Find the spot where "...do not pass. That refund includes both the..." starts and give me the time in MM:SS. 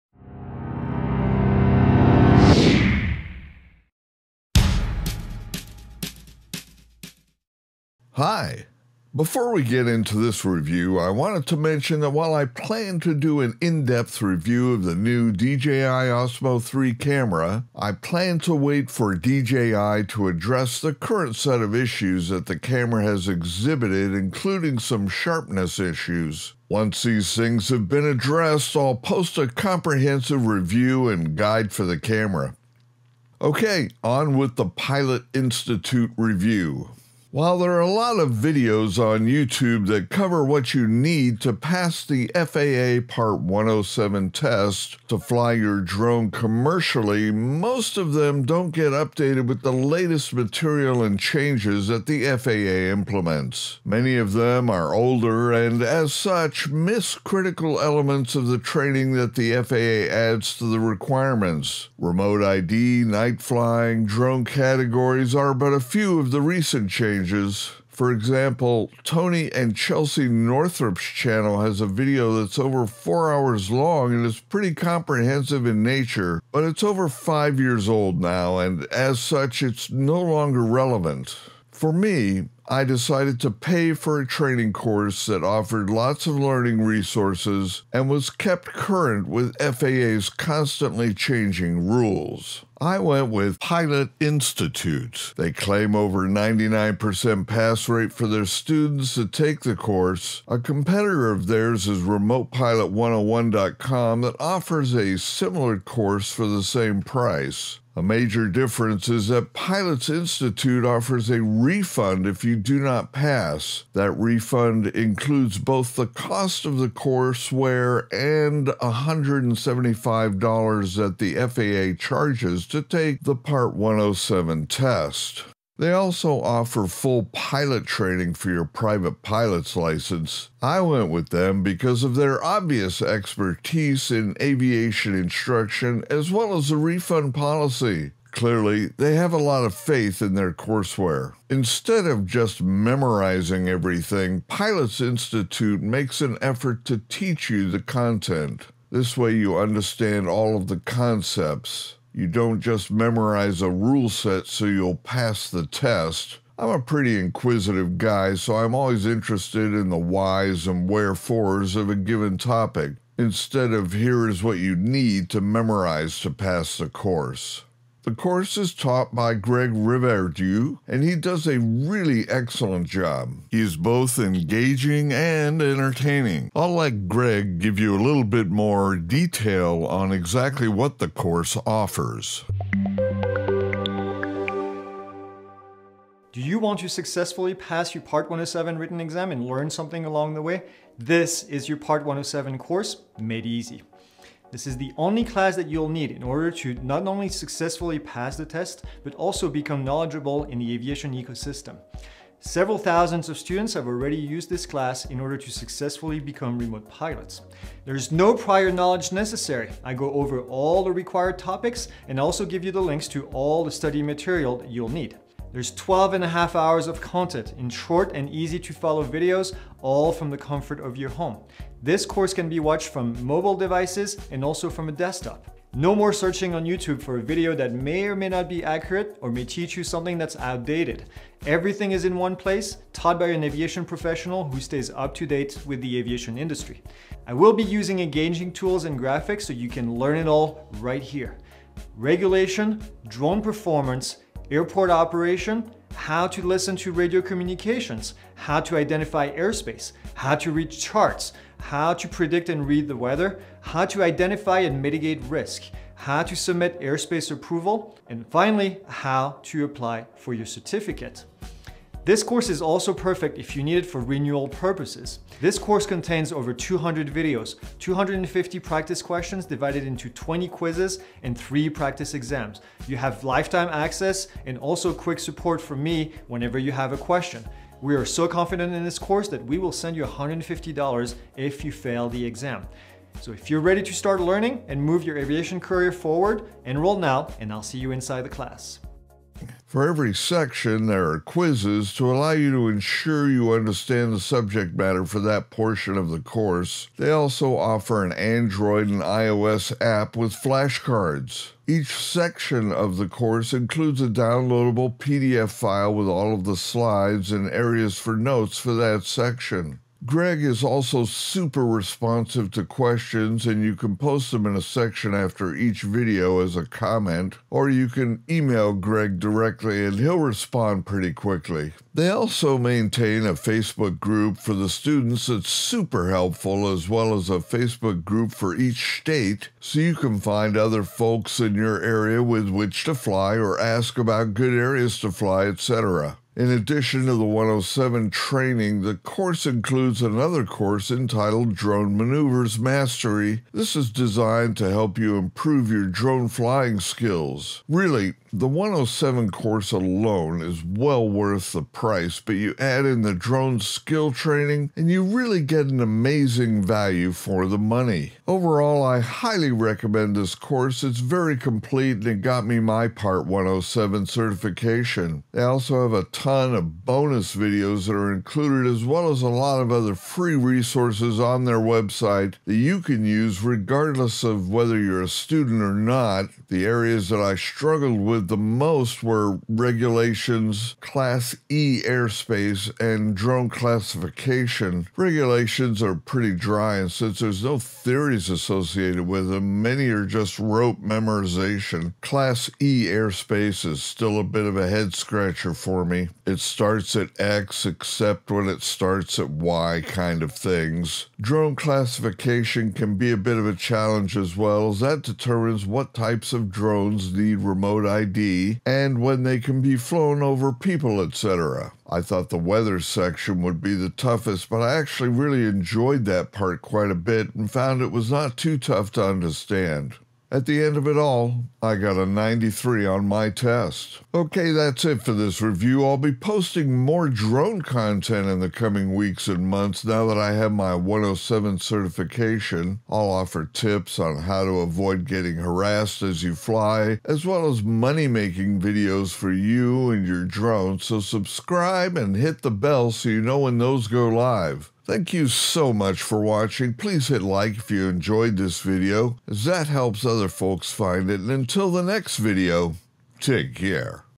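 01:52.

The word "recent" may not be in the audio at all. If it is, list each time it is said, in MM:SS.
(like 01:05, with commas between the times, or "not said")
01:06.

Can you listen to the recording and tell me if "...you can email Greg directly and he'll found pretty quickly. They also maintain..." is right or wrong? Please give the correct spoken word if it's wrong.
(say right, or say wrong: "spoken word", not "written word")
wrong: "respond", not "found".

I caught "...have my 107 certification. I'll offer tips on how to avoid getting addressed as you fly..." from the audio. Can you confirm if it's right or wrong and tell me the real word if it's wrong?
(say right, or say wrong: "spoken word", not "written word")
wrong: "harassed", not "addressed".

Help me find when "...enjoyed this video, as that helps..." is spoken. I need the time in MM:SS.
07:27.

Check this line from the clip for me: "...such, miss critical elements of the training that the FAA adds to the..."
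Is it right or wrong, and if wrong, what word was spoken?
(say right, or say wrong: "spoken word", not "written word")
right.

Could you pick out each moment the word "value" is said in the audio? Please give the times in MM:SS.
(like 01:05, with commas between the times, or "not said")
05:56.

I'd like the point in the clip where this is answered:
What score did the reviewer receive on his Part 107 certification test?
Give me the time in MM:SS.
07:02.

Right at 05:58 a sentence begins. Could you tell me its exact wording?
Overall, I highly recommend this course.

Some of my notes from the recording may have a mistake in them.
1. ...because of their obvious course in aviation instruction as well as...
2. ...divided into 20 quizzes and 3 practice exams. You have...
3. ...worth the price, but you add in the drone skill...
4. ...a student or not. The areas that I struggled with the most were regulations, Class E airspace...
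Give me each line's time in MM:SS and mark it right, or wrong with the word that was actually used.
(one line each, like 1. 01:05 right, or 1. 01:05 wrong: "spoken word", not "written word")
1. 02:11 wrong: "expertise", not "course"
2. 04:29 right
3. 05:51 right
4. 06:15 right.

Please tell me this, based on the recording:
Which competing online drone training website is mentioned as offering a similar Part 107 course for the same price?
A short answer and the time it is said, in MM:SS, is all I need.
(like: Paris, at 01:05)
RemotePilot101.com, at 01:42.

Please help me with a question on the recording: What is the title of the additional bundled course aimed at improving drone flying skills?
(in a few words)
Drone Maneuvers Mastery.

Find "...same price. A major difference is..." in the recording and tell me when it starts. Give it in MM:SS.
01:46.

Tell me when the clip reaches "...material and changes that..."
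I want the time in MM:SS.
00:50.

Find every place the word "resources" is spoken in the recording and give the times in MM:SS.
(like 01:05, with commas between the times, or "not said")
01:26, 06:10.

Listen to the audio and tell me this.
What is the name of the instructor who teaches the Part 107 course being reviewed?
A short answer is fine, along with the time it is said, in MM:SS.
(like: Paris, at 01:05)
Greg Reverdiau, at 02:49.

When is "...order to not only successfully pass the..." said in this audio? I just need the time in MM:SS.
03:16.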